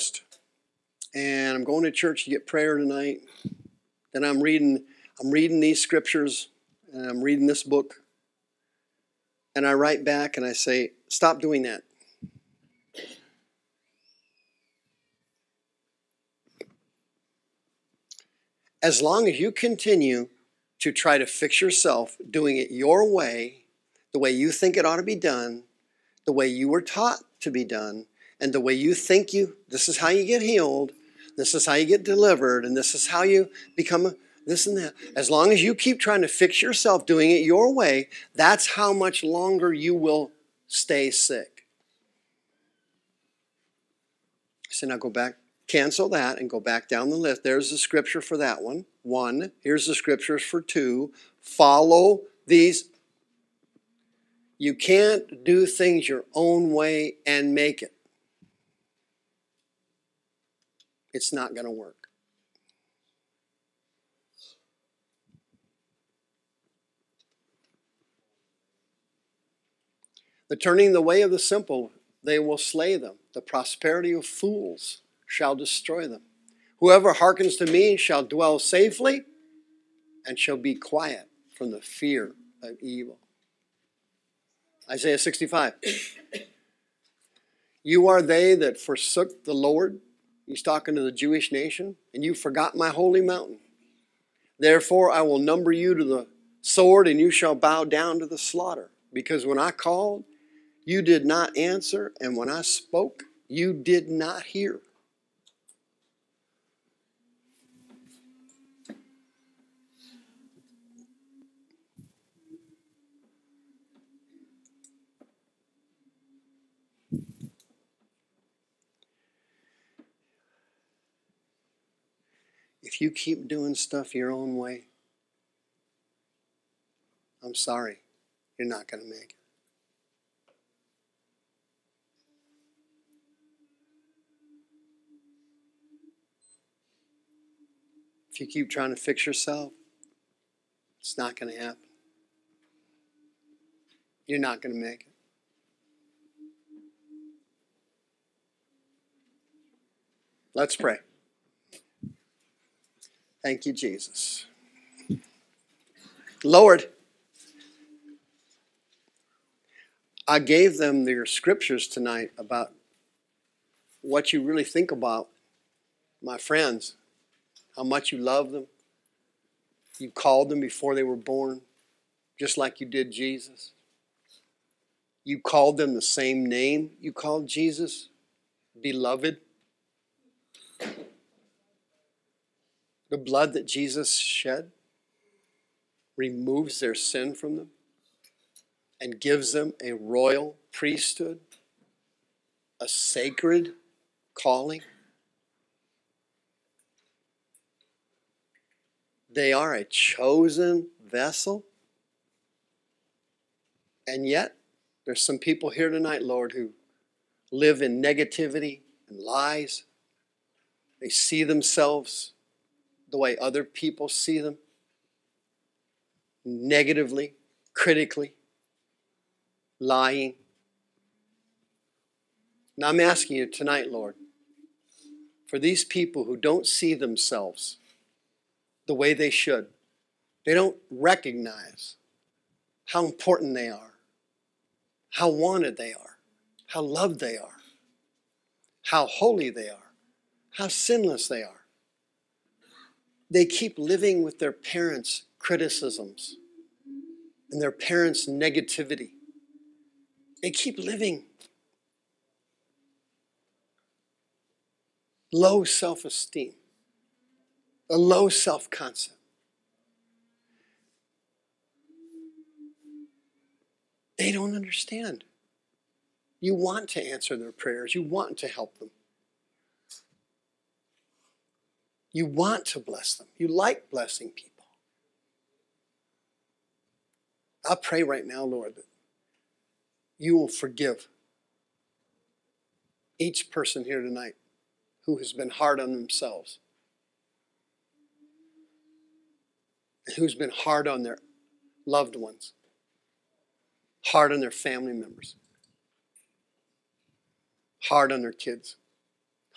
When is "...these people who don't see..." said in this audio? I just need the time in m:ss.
3:45.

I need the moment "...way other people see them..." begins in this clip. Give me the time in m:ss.
3:33.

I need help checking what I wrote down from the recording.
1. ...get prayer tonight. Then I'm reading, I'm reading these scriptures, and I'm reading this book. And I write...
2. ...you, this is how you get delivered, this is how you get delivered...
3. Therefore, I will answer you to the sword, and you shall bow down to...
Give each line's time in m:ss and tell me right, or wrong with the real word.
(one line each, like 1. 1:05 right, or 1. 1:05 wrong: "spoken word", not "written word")
1. 0:02 right
2. 0:29 wrong: "healed", not "delivered"
3. 1:34 wrong: "number", not "answer".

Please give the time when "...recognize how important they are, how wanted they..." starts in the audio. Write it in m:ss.
3:50.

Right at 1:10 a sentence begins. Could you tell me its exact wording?
But turning the way of the simple, they will slay them.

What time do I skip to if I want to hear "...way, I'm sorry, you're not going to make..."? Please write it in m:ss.
2:04.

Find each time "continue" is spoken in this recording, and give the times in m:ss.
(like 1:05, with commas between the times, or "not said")
0:19.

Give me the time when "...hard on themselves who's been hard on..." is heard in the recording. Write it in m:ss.
4:45.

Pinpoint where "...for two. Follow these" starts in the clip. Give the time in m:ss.
0:50.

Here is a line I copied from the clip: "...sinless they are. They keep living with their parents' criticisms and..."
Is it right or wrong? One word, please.
right.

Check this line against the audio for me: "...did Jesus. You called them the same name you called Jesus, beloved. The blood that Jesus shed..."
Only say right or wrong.
right.